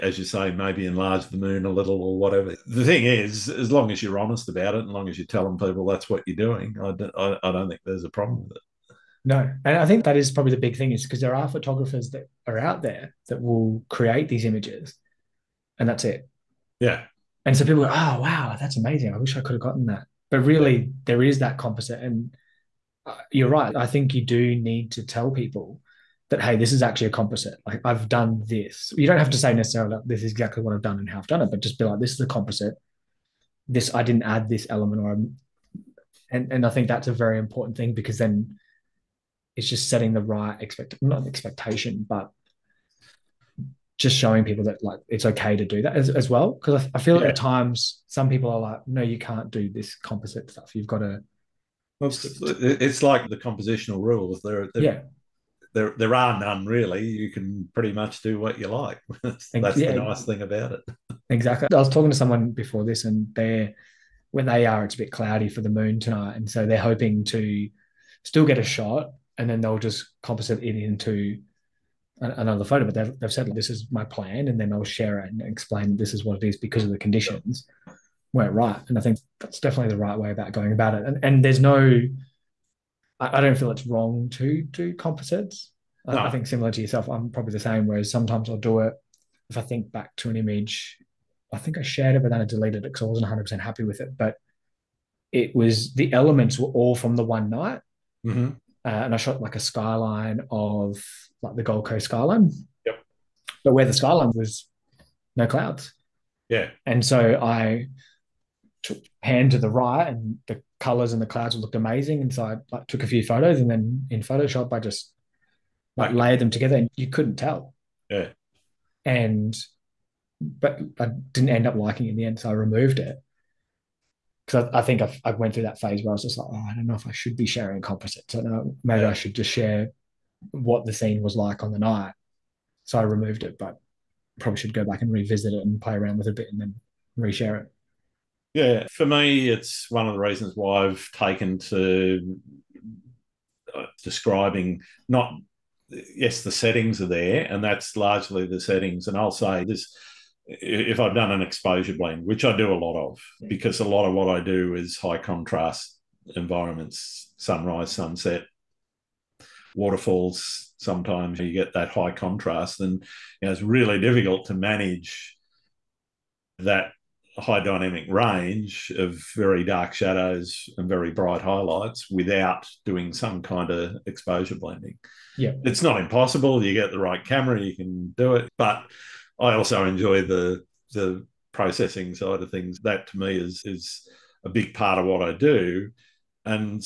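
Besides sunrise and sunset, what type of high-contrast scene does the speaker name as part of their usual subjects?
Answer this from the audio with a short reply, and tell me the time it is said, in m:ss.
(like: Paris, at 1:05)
Waterfalls, at 2:39.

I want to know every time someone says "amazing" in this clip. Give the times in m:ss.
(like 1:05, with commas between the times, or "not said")
0:18, 1:51.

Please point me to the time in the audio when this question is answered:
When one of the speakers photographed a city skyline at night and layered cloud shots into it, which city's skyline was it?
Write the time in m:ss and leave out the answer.
1:41.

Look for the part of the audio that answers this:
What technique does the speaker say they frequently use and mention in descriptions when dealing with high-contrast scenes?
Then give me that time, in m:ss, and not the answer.
2:31.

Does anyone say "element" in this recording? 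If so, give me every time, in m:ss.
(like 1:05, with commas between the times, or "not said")
0:34, 1:36.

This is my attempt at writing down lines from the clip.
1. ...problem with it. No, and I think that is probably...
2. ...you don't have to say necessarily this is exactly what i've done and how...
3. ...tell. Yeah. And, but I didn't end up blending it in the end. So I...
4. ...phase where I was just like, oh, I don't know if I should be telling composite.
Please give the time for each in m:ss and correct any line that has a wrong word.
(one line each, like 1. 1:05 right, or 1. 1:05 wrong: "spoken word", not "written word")
1. 0:08 right
2. 0:28 right
3. 1:57 wrong: "liking", not "blending"
4. 2:05 wrong: "sharing", not "telling".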